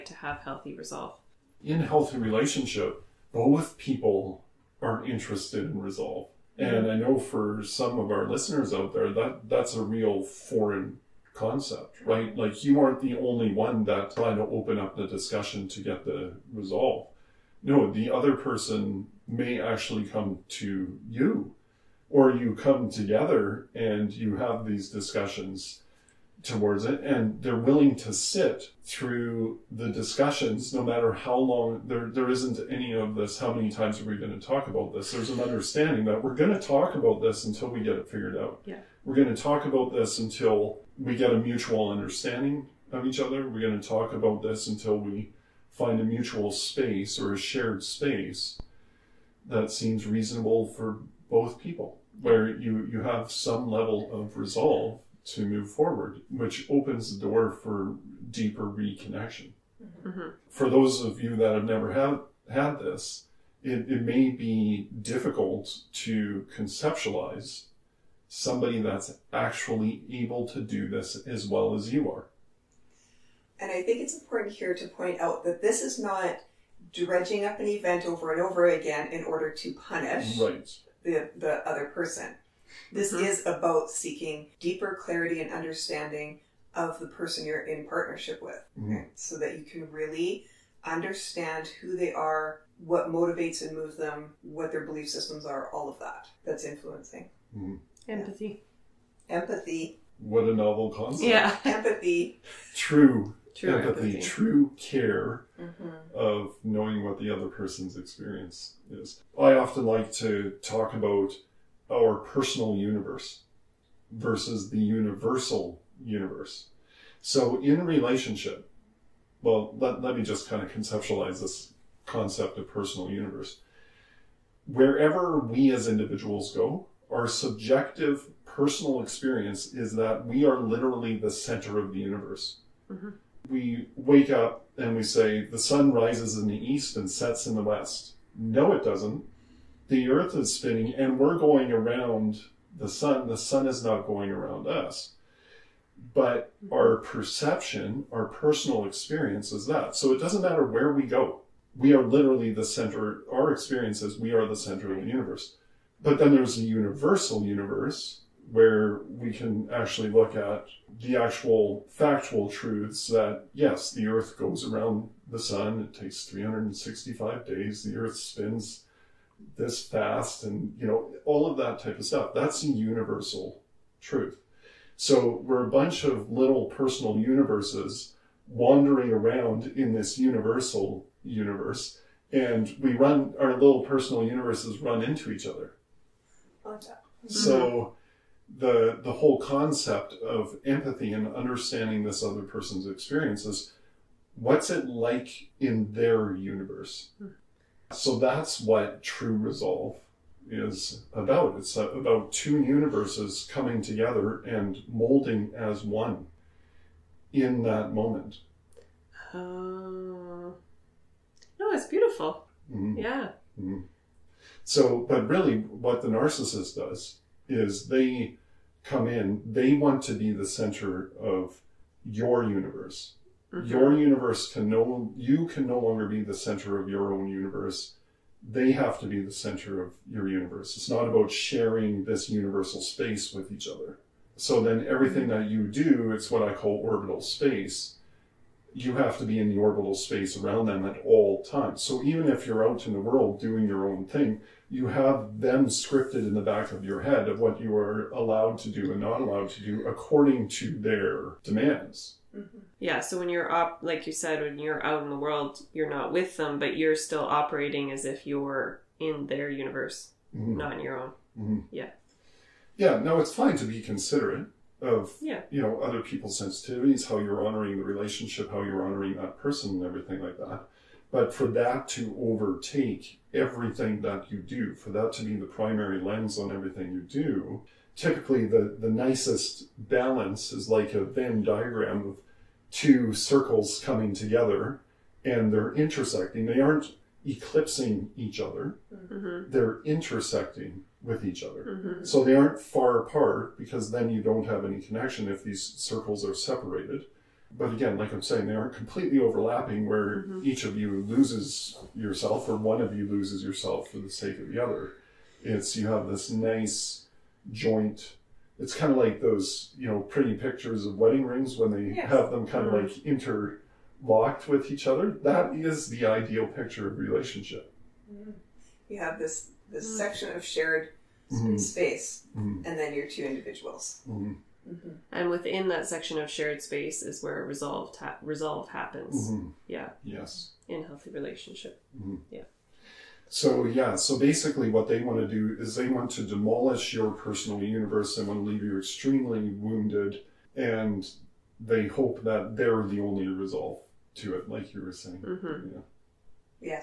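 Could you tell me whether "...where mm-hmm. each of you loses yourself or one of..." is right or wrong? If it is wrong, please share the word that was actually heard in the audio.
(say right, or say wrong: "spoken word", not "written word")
right.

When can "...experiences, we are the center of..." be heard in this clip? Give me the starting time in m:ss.
2:33.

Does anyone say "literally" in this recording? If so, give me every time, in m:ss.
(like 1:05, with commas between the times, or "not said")
2:10, 2:32.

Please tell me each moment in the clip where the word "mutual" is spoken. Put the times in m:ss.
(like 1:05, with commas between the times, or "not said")
0:41, 0:46.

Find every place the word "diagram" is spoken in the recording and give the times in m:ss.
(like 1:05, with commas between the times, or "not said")
4:41.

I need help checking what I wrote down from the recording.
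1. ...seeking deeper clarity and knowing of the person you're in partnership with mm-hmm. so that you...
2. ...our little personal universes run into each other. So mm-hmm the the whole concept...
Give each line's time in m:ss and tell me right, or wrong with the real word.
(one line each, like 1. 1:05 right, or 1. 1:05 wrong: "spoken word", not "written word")
1. 1:23 wrong: "understanding", not "knowing"
2. 3:03 right.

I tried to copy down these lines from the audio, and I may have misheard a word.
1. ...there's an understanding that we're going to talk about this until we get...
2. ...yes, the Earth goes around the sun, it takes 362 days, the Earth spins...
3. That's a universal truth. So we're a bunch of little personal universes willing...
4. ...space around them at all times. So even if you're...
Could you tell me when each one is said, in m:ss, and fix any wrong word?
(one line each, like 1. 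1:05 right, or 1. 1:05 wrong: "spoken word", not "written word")
1. 0:35 right
2. 2:43 wrong: "365", not "362"
3. 2:52 wrong: "wandering", not "willing"
4. 3:59 right.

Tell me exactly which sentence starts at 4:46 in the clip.
They aren't eclipsing each other, mm-hmm.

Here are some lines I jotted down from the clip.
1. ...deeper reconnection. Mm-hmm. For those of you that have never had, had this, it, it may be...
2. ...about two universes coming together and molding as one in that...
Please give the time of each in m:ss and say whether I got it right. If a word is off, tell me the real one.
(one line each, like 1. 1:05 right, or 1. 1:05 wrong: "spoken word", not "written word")
1. 0:58 right
2. 3:21 right.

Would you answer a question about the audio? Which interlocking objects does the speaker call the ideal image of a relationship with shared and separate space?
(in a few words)
wedding rings.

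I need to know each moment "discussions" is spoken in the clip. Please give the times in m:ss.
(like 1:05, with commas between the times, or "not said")
0:15, 0:24, 0:29.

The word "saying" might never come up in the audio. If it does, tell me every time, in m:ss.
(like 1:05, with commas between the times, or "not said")
4:58, 5:44.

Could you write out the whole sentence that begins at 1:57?
So, in relationship, well, let, let me just kind of conceptualize this concept of personal universe.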